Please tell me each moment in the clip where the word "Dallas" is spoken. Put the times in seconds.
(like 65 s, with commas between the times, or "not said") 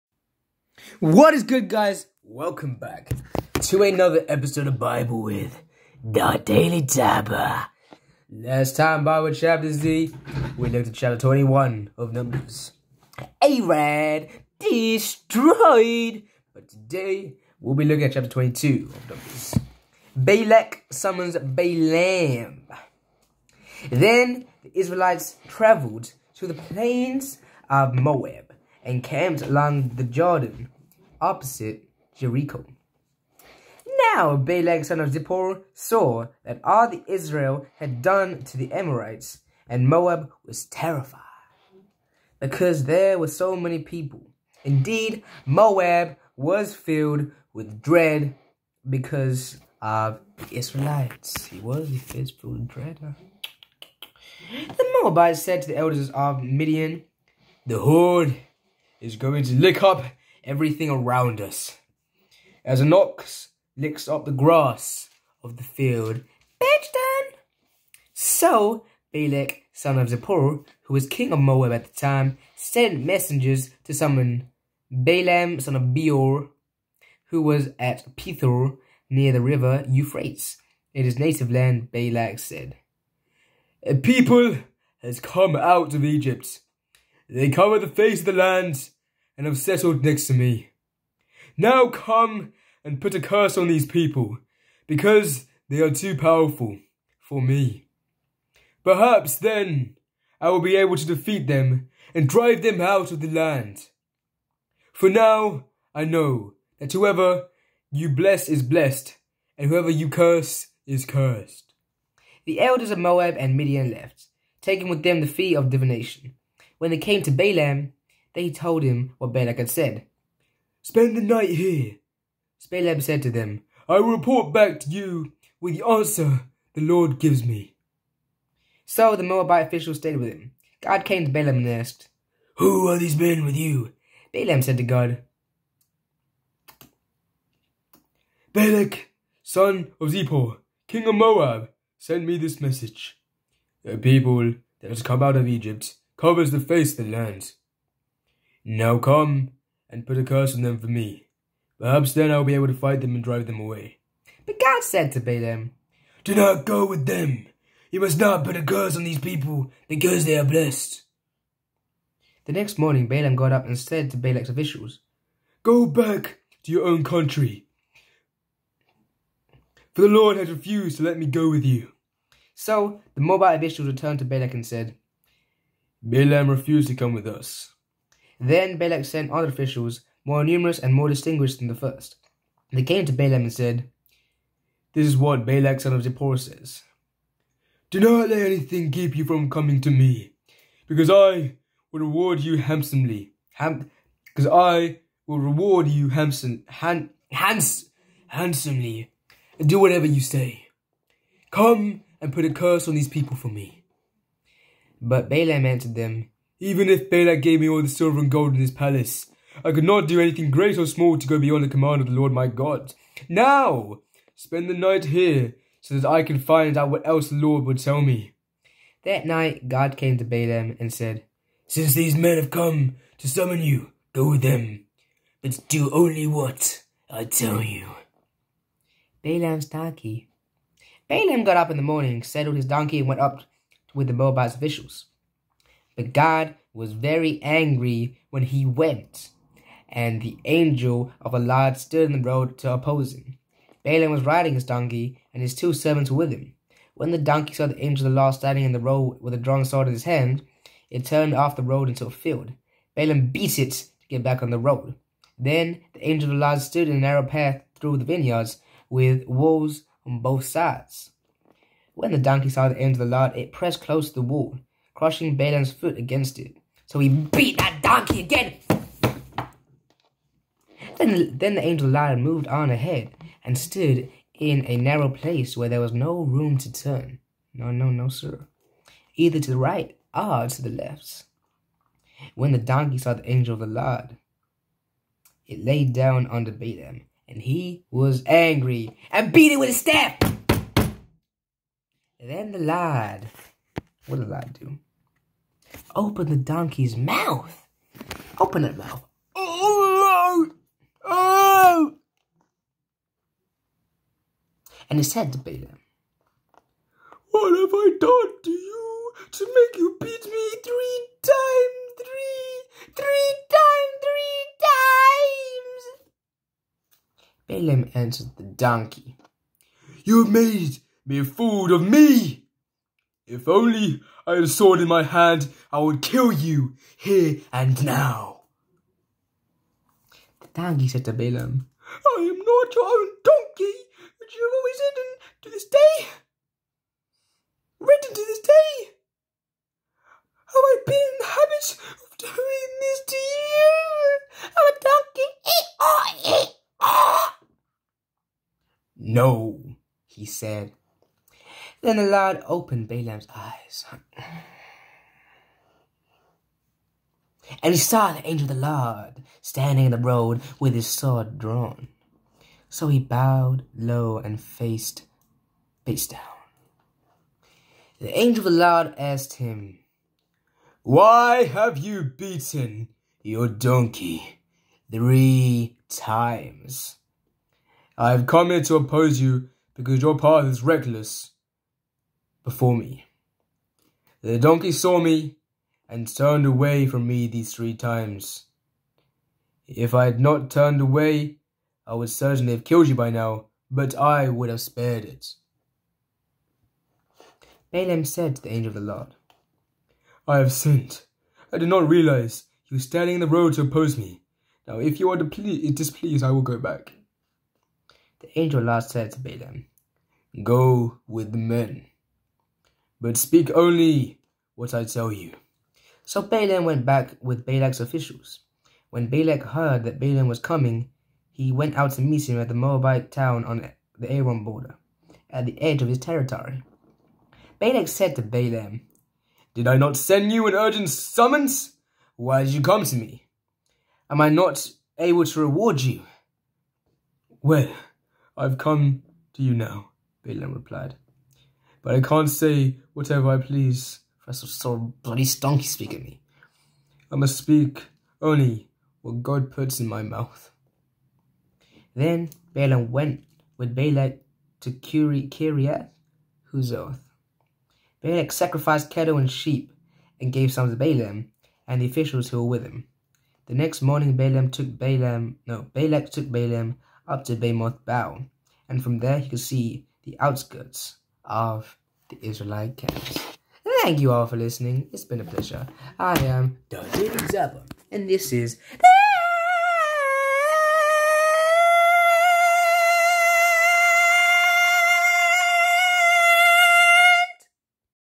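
not said.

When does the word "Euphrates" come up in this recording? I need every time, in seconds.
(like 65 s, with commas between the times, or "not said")
79 s.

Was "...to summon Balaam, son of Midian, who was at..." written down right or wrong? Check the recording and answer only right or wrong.
wrong.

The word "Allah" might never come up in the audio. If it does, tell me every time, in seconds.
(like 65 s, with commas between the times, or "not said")
241 s, 248 s, 256 s, 263 s.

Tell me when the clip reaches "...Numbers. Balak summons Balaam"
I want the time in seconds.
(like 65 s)
19 s.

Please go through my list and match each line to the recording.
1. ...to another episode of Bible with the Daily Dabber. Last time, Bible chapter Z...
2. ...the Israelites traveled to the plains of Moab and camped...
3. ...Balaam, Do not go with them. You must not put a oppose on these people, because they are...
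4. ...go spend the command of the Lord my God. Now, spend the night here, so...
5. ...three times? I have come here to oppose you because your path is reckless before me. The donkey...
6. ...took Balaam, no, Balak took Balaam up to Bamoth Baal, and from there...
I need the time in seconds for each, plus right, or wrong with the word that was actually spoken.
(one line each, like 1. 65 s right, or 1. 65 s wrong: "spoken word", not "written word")
1. 3 s right
2. 24 s right
3. 155 s wrong: "curse", not "oppose"
4. 211 s wrong: "beyond", not "spend"
5. 374 s right
6. 464 s right.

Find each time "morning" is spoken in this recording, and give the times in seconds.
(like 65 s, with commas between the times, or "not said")
162 s, 231 s, 463 s.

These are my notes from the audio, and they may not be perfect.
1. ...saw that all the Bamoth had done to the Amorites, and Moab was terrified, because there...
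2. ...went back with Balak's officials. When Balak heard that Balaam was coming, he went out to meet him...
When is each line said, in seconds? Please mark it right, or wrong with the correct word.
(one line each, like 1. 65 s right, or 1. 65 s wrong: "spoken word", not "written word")
1. 35 s wrong: "Israel", not "Bamoth"
2. 416 s right.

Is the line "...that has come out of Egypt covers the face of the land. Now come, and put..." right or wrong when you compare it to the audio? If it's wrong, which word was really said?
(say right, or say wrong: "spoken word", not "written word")
right.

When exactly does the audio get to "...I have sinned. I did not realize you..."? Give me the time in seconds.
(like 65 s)
400 s.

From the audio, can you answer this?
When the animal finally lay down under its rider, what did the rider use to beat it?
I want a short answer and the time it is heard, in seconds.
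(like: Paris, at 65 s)
A staff, at 289 s.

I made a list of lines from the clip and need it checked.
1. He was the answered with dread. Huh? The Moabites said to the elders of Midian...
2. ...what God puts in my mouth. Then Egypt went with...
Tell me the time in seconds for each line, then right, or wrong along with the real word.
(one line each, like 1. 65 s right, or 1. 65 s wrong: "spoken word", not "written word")
1. 51 s wrong: "filled", not "answered"
2. 449 s wrong: "Balaam", not "Egypt".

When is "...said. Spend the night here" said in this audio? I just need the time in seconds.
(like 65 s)
119 s.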